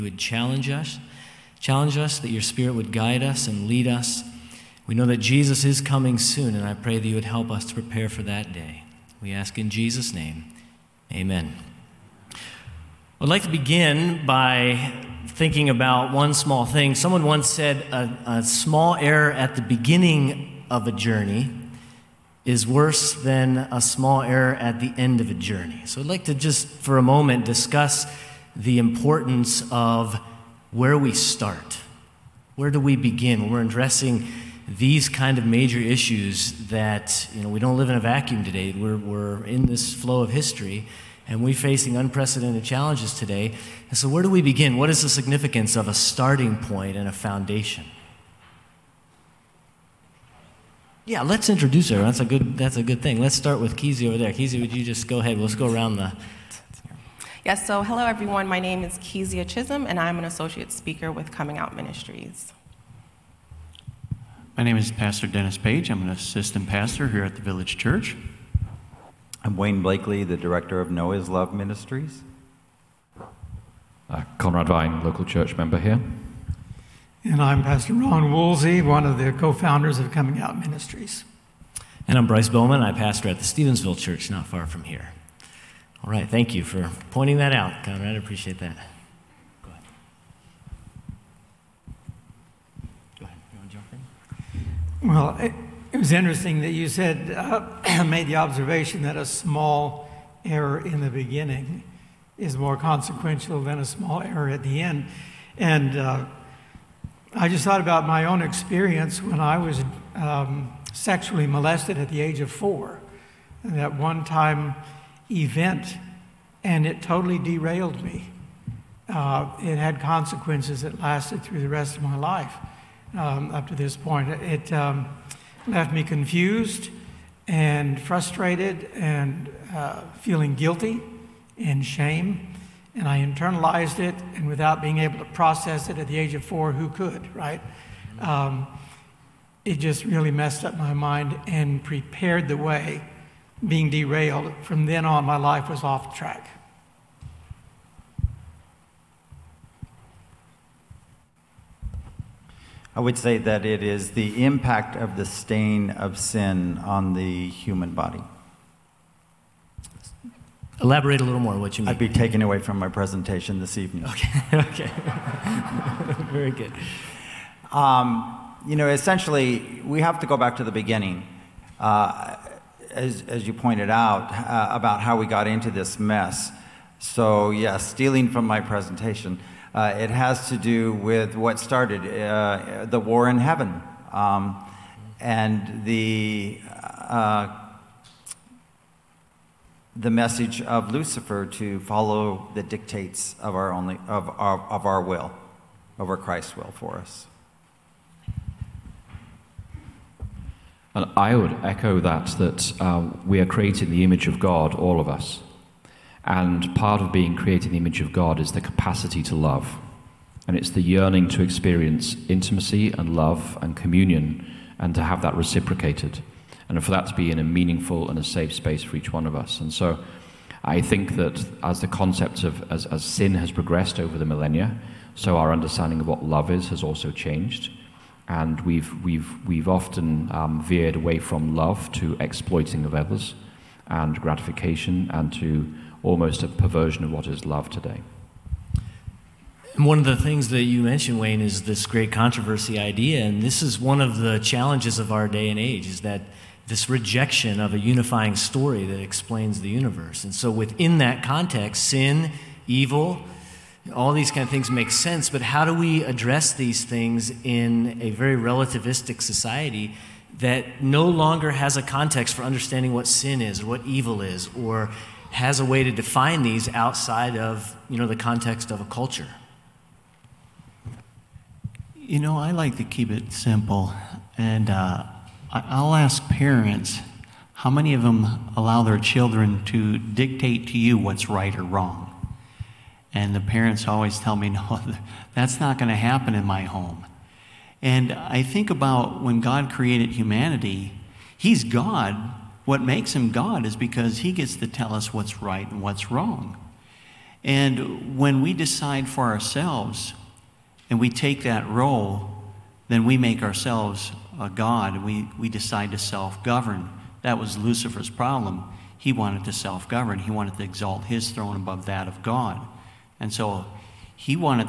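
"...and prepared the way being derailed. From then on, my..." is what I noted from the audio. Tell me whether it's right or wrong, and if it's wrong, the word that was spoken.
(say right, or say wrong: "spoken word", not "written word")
right.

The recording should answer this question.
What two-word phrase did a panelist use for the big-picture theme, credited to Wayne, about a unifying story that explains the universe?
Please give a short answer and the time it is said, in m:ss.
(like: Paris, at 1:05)
great controversy, at 4:01.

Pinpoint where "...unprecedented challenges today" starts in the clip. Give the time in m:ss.
0:41.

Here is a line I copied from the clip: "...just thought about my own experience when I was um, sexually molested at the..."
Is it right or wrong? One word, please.
right.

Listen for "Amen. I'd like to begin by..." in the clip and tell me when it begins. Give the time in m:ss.
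0:11.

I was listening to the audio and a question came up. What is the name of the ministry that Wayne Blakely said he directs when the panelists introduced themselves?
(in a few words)
Noah's Love Ministries.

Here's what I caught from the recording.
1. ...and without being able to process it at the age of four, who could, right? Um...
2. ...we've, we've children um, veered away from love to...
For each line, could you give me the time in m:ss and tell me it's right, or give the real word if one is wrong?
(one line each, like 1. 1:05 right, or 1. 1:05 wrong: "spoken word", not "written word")
1. 2:14 right
2. 3:49 wrong: "often", not "children".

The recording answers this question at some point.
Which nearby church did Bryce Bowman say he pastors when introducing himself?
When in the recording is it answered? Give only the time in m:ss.
1:23.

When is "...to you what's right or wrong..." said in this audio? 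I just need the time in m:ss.
4:40.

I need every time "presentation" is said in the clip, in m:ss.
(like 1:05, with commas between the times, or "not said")
2:42, 2:58.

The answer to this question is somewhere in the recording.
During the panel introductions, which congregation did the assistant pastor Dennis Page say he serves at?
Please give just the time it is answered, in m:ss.
1:07.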